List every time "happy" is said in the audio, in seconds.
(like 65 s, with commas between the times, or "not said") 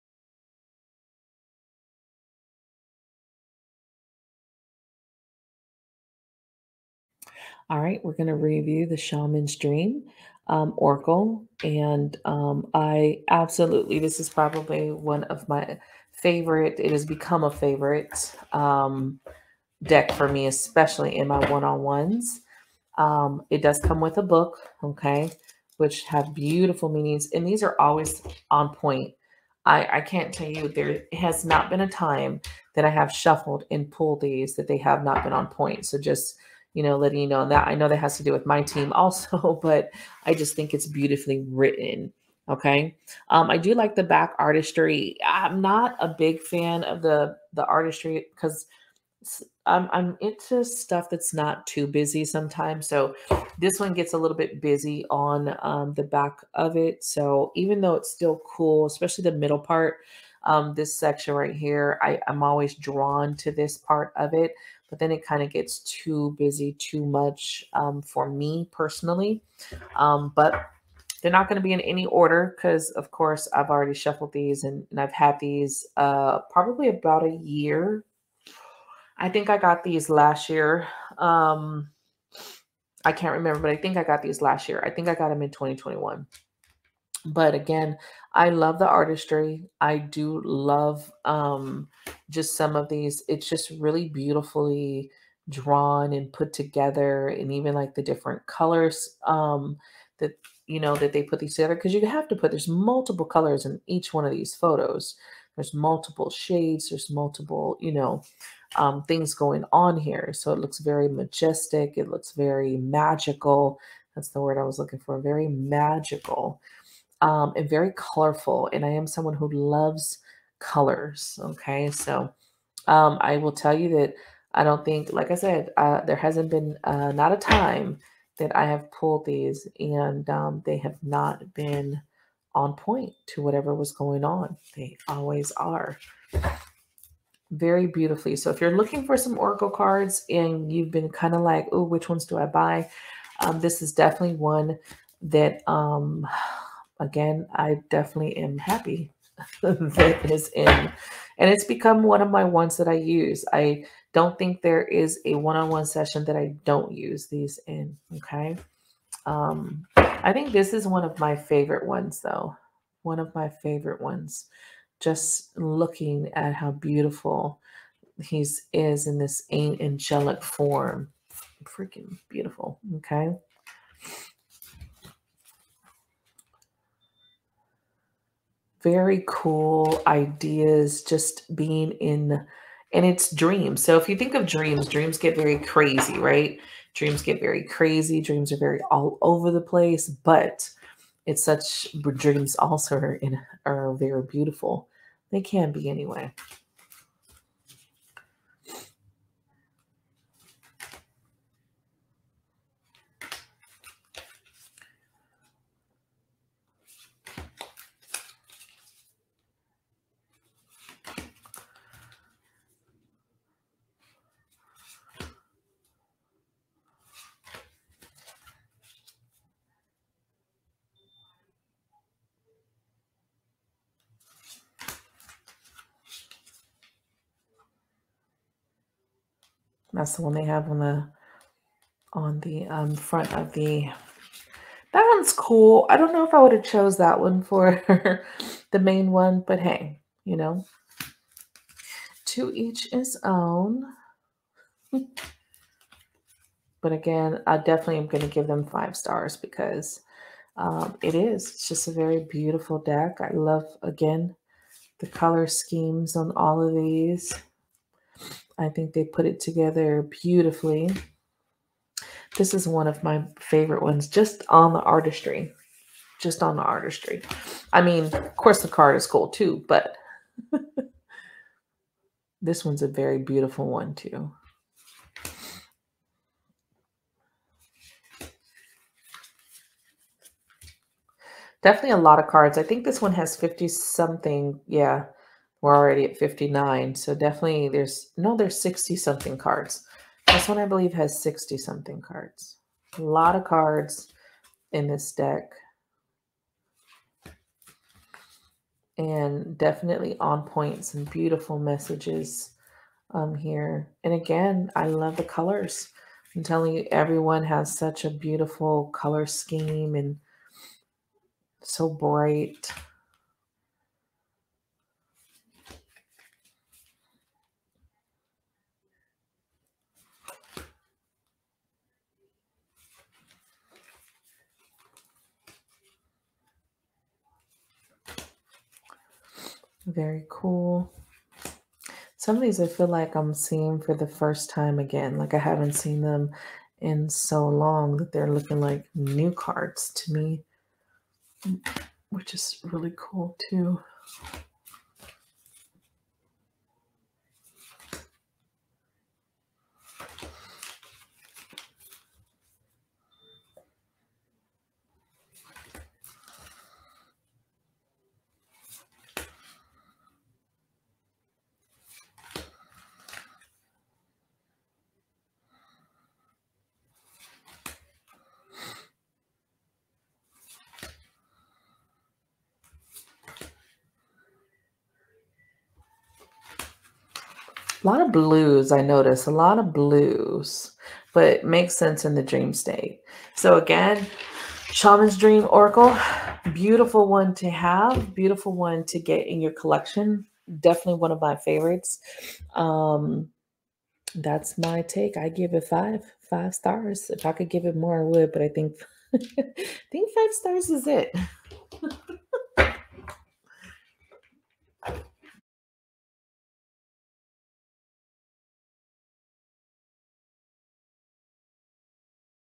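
148 s.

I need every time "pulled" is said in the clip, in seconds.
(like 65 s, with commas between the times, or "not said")
33 s, 128 s.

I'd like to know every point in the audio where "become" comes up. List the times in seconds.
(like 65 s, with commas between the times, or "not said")
17 s, 151 s.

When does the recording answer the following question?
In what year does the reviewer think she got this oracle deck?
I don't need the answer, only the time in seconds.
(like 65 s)
85 s.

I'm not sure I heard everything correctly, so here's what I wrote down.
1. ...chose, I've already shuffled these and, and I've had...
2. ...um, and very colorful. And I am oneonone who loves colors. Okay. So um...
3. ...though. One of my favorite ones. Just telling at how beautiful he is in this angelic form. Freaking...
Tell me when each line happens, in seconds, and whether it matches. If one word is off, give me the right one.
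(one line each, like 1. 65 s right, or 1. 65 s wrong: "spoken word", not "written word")
1. 73 s wrong: "course", not "chose"
2. 117 s wrong: "someone", not "oneonone"
3. 162 s wrong: "looking", not "telling".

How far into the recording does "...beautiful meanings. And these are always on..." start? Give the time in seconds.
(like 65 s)
26 s.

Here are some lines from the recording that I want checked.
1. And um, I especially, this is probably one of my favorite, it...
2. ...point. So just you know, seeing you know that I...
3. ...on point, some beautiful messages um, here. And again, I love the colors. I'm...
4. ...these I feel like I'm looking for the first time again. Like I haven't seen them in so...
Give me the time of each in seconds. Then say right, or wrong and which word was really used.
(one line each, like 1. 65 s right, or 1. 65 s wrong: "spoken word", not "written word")
1. 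11 s wrong: "absolutely", not "especially"
2. 35 s wrong: "letting", not "seeing"
3. 300 s right
4. 332 s wrong: "seeing", not "looking".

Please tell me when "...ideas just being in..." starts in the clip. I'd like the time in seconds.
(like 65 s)
180 s.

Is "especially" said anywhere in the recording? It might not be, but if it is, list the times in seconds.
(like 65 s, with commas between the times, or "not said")
20 s, 58 s.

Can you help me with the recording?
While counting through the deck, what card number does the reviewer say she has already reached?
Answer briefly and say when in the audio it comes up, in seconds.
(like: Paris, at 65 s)
59, at 286 s.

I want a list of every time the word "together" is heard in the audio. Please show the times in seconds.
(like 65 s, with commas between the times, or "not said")
96 s, 101 s, 259 s.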